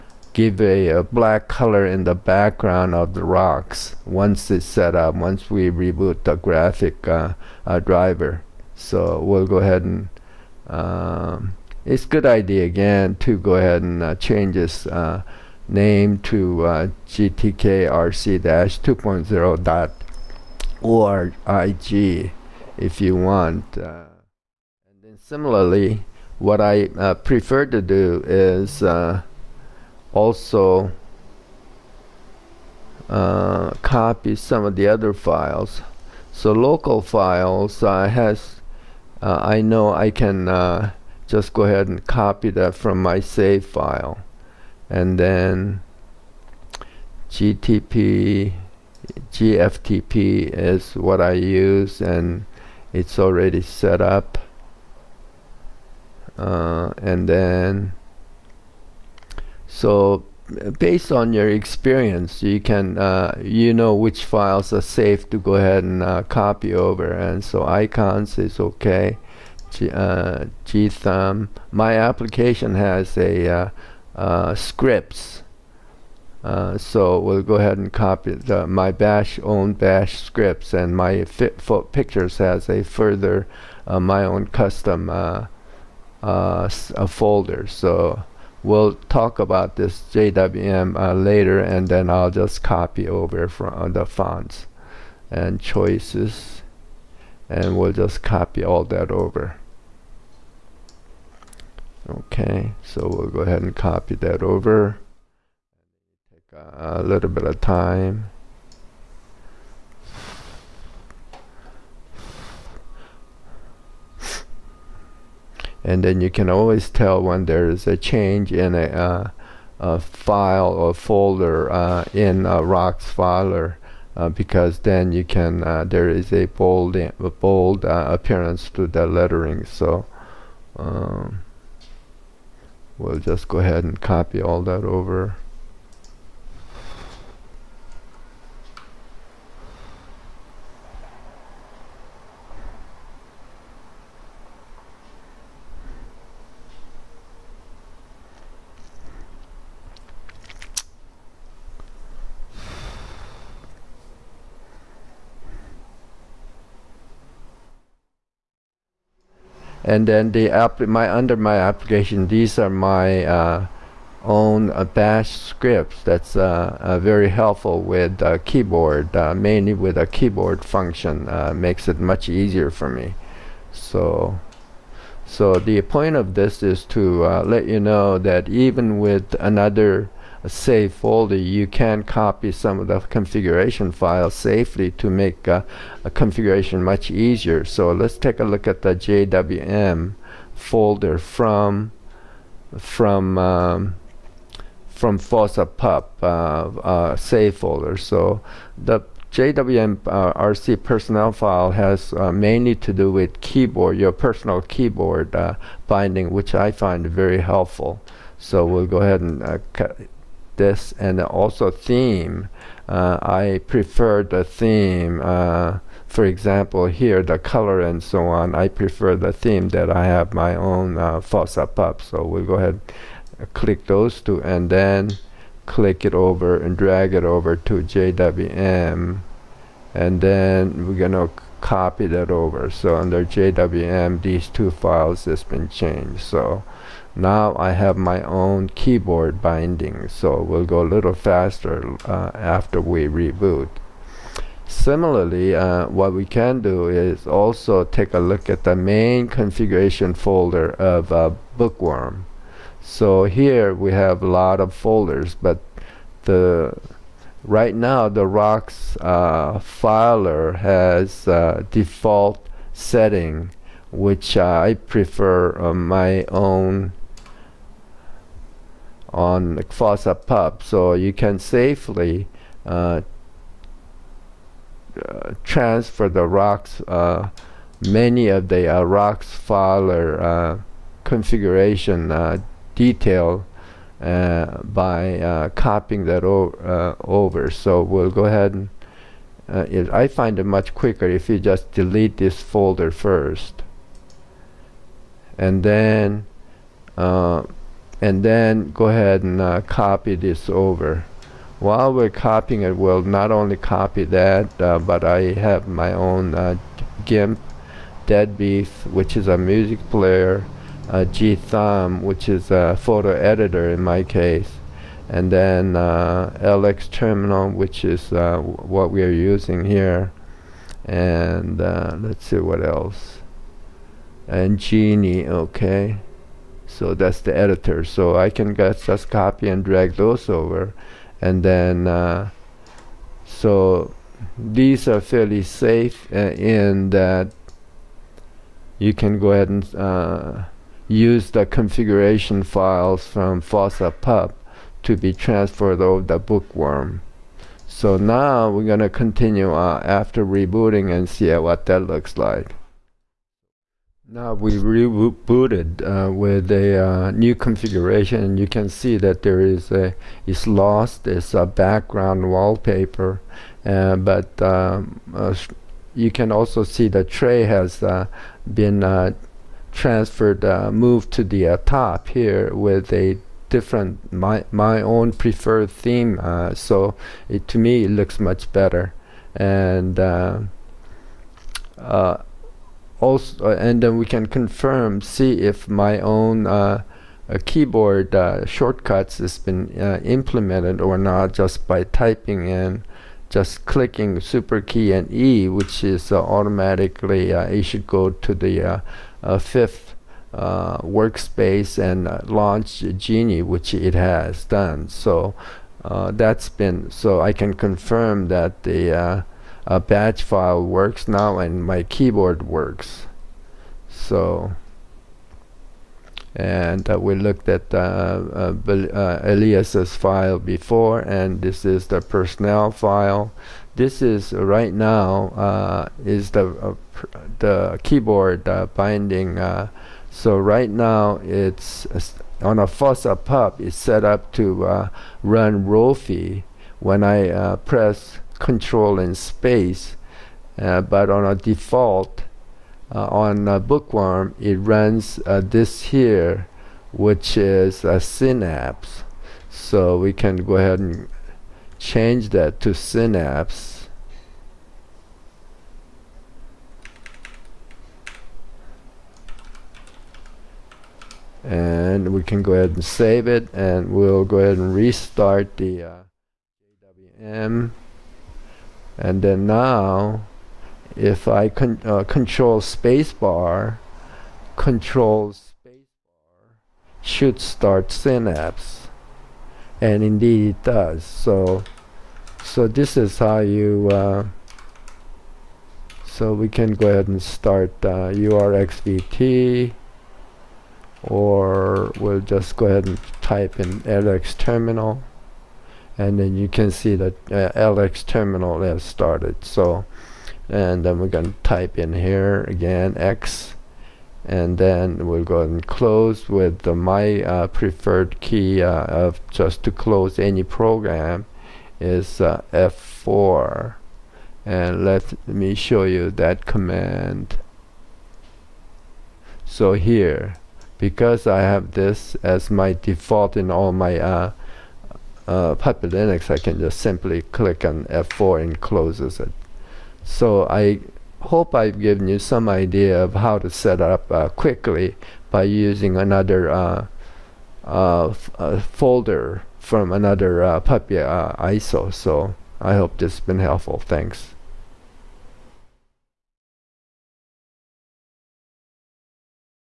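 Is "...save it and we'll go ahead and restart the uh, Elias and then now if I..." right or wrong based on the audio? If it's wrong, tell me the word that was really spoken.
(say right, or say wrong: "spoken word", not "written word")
wrong: "JWM", not "Elias".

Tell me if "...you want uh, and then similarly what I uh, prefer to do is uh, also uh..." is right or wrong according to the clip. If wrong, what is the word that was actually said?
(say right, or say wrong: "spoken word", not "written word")
right.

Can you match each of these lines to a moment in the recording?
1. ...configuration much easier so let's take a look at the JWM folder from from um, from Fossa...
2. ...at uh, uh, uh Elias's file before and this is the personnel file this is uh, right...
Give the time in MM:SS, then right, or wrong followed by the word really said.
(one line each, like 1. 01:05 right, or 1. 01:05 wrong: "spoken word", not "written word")
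1. 03:06 right
2. 06:57 right.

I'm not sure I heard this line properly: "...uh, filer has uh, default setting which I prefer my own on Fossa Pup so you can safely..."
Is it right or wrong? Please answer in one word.
right.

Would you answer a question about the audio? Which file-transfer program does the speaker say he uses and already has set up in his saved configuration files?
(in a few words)
gFTP.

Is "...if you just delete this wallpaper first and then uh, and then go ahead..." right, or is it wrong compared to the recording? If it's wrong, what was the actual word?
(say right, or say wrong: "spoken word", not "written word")
wrong: "folder", not "wallpaper".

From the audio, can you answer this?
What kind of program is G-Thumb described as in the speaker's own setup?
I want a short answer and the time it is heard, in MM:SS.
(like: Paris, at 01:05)
Photo editor, at 05:12.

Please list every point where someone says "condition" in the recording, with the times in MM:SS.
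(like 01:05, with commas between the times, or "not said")
not said.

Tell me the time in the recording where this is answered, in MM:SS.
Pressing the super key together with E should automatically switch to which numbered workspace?
06:39.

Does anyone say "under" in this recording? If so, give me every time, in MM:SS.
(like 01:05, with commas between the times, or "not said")
02:41, 03:52.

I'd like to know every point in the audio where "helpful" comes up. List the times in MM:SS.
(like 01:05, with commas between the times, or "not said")
02:47, 03:27, 09:03.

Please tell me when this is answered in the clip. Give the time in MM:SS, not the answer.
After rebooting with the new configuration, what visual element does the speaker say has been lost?
06:01.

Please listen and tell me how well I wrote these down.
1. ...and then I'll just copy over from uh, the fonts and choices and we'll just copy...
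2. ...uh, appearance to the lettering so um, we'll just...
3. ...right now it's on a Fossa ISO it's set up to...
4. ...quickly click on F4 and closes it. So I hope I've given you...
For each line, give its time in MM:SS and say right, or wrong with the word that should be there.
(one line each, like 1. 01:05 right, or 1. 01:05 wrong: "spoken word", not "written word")
1. 01:31 right
2. 02:07 right
3. 07:10 wrong: "Pup", not "ISO"
4. 08:46 wrong: "simply", not "quickly".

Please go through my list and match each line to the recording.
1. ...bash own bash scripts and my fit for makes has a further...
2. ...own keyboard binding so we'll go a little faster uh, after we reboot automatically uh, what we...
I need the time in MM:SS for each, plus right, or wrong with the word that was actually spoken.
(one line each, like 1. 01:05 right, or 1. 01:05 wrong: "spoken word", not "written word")
1. 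01:18 wrong: "pictures", not "makes"
2. 03:58 wrong: "similarly", not "automatically".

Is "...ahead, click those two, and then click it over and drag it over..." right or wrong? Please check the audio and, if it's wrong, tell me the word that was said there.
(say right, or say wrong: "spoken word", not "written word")
right.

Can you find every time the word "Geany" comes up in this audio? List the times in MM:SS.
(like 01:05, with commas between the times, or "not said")
05:24, 06:42.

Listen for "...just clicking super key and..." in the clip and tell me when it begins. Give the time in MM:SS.
06:33.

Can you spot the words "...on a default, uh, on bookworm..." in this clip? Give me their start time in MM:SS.
07:21.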